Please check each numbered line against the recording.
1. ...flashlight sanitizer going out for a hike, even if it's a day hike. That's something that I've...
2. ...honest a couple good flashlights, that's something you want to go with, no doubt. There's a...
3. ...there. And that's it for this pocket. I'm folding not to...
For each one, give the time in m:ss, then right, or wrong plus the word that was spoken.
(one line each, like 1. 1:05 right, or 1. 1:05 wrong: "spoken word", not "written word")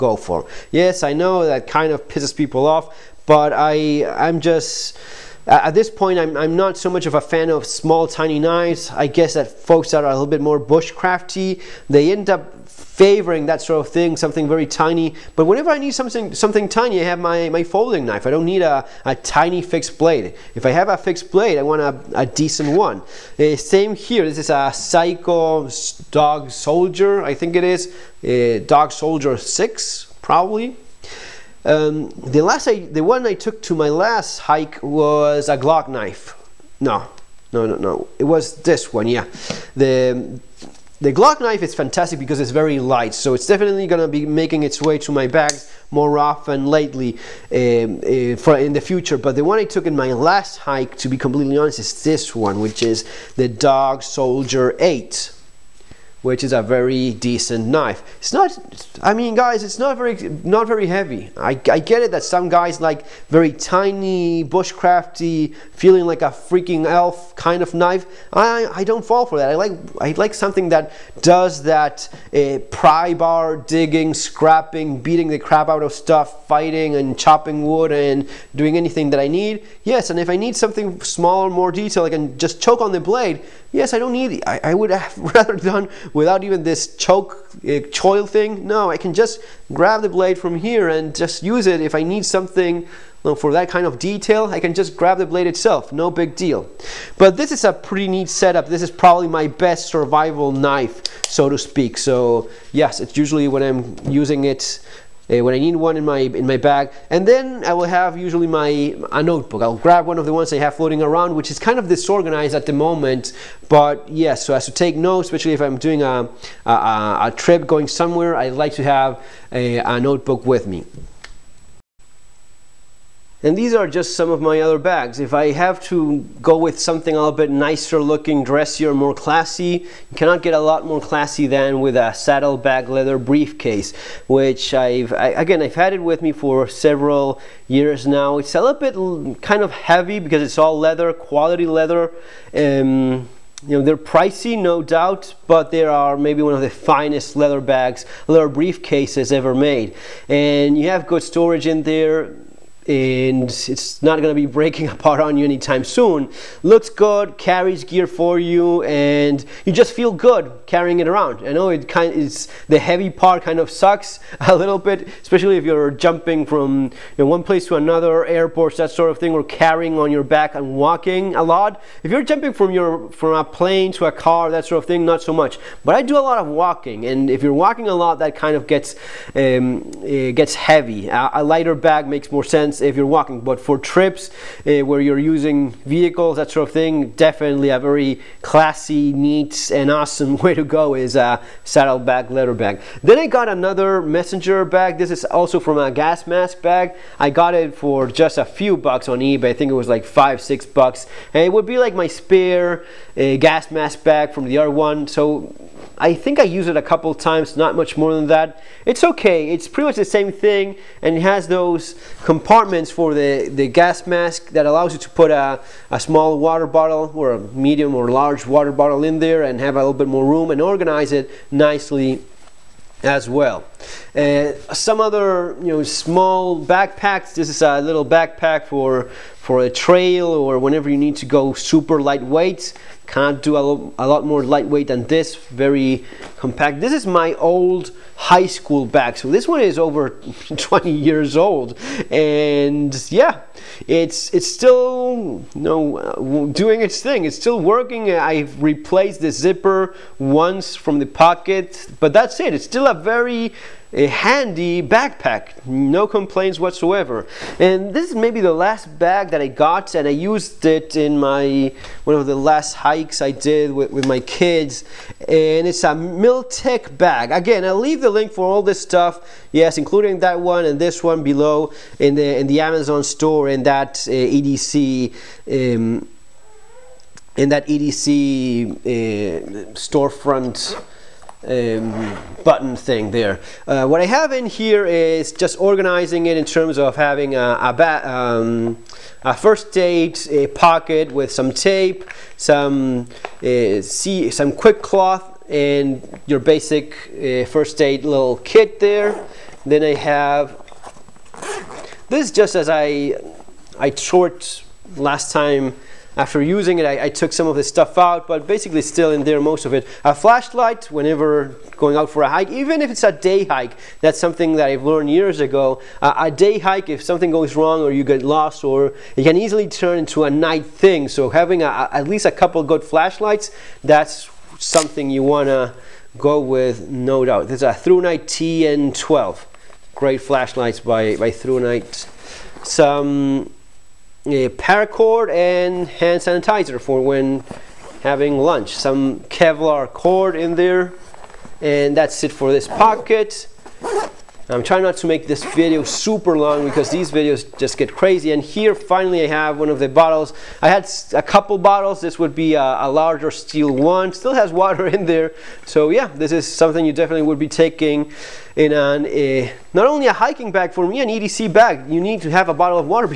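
1. 5:10 wrong: "whenever", not "sanitizer"
2. 5:22 wrong: "least", not "honest"
3. 5:40 wrong: "trying", not "folding".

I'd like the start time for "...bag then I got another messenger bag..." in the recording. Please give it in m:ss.
3:12.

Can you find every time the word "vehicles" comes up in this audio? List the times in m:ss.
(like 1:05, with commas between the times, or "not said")
3:05.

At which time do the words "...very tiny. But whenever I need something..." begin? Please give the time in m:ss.
0:14.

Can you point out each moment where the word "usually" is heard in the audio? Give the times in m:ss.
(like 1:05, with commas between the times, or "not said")
1:43, 1:48.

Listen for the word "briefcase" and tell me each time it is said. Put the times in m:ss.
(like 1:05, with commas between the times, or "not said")
2:13, 2:28.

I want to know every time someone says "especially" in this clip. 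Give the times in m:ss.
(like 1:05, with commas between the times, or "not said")
1:55, 2:45.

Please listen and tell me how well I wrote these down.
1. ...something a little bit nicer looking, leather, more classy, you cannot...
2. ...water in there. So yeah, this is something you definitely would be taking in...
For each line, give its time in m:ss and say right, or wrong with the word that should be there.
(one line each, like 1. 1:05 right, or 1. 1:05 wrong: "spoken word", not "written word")
1. 2:06 wrong: "dressier", not "leather"
2. 5:54 right.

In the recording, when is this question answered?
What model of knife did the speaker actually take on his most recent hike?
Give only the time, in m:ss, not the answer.
0:53.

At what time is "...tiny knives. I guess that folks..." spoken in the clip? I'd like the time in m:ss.
0:08.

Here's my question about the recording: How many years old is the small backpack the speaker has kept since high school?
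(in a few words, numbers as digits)
20.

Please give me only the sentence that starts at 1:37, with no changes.
But this is a pretty neat setup.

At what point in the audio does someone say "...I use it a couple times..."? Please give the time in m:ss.
3:26.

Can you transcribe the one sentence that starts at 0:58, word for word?
It's not, I mean guys, it's not very, not very heavy.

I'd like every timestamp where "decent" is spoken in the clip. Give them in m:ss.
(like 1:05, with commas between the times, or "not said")
0:22, 0:57.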